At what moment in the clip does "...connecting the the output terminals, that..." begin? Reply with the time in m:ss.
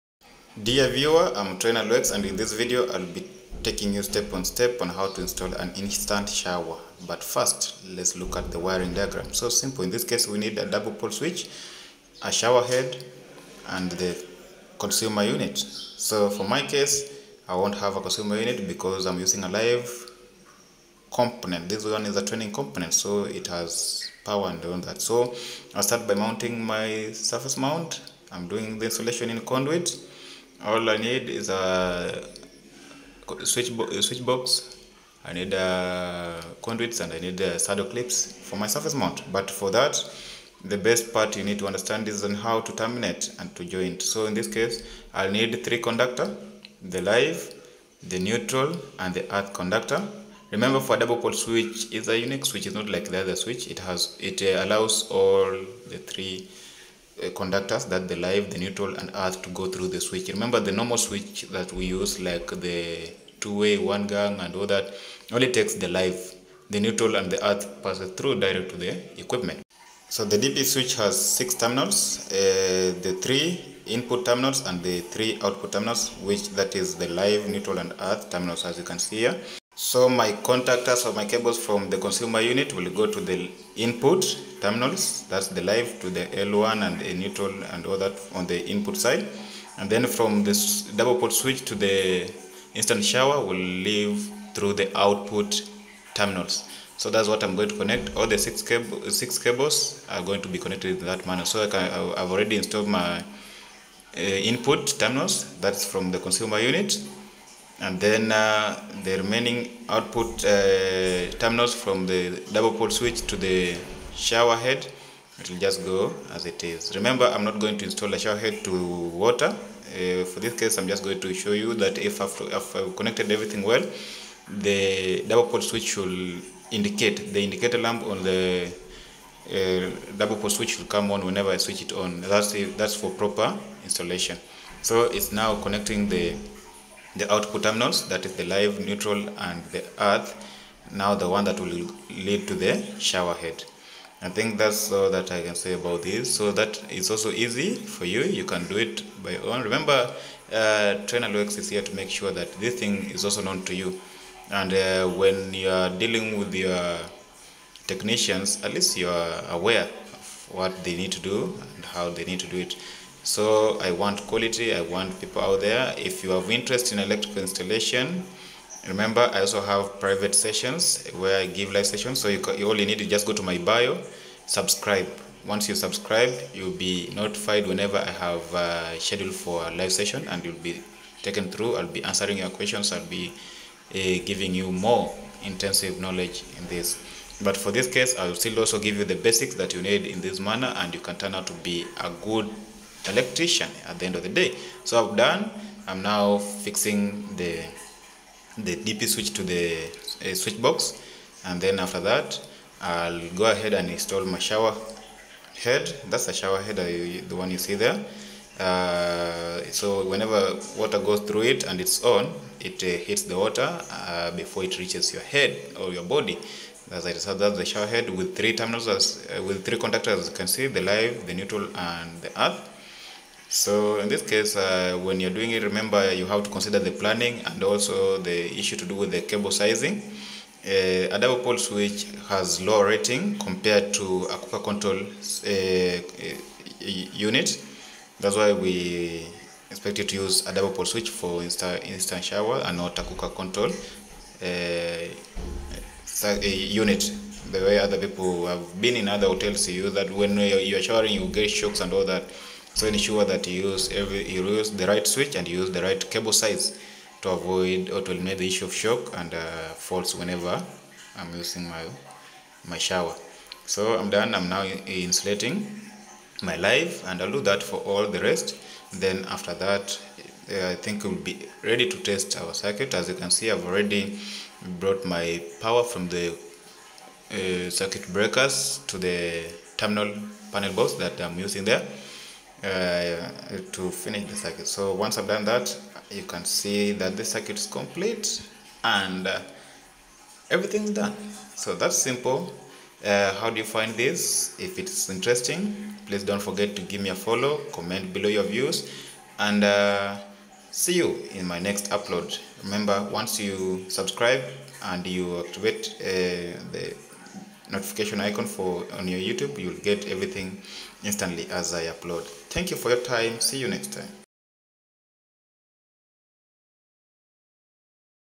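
2:15.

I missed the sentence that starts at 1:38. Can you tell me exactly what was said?
All the six, cable, six cables are going to be connected in that manner.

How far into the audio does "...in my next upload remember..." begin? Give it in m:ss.
5:01.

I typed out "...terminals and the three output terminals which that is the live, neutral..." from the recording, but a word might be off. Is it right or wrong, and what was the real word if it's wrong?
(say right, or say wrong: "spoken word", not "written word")
right.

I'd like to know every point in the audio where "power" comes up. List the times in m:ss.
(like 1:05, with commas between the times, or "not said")
0:24, 4:35.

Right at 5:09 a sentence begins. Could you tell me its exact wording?
You'll get everything instantly as I upload.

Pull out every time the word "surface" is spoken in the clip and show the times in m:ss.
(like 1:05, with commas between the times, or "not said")
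0:27, 0:38.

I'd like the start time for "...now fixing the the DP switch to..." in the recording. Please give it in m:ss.
3:16.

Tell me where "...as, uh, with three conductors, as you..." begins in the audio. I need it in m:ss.
3:38.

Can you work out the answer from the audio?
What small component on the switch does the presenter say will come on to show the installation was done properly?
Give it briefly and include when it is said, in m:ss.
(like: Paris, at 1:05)
indicator lamp, at 2:07.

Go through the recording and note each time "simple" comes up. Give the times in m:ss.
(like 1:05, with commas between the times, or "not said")
0:09, 4:51.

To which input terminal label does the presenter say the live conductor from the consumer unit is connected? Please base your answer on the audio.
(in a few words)
L1.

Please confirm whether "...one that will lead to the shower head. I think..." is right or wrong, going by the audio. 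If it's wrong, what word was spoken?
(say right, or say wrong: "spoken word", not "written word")
right.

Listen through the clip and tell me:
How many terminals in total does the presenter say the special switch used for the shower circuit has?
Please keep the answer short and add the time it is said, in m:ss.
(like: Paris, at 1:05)
6, at 1:11.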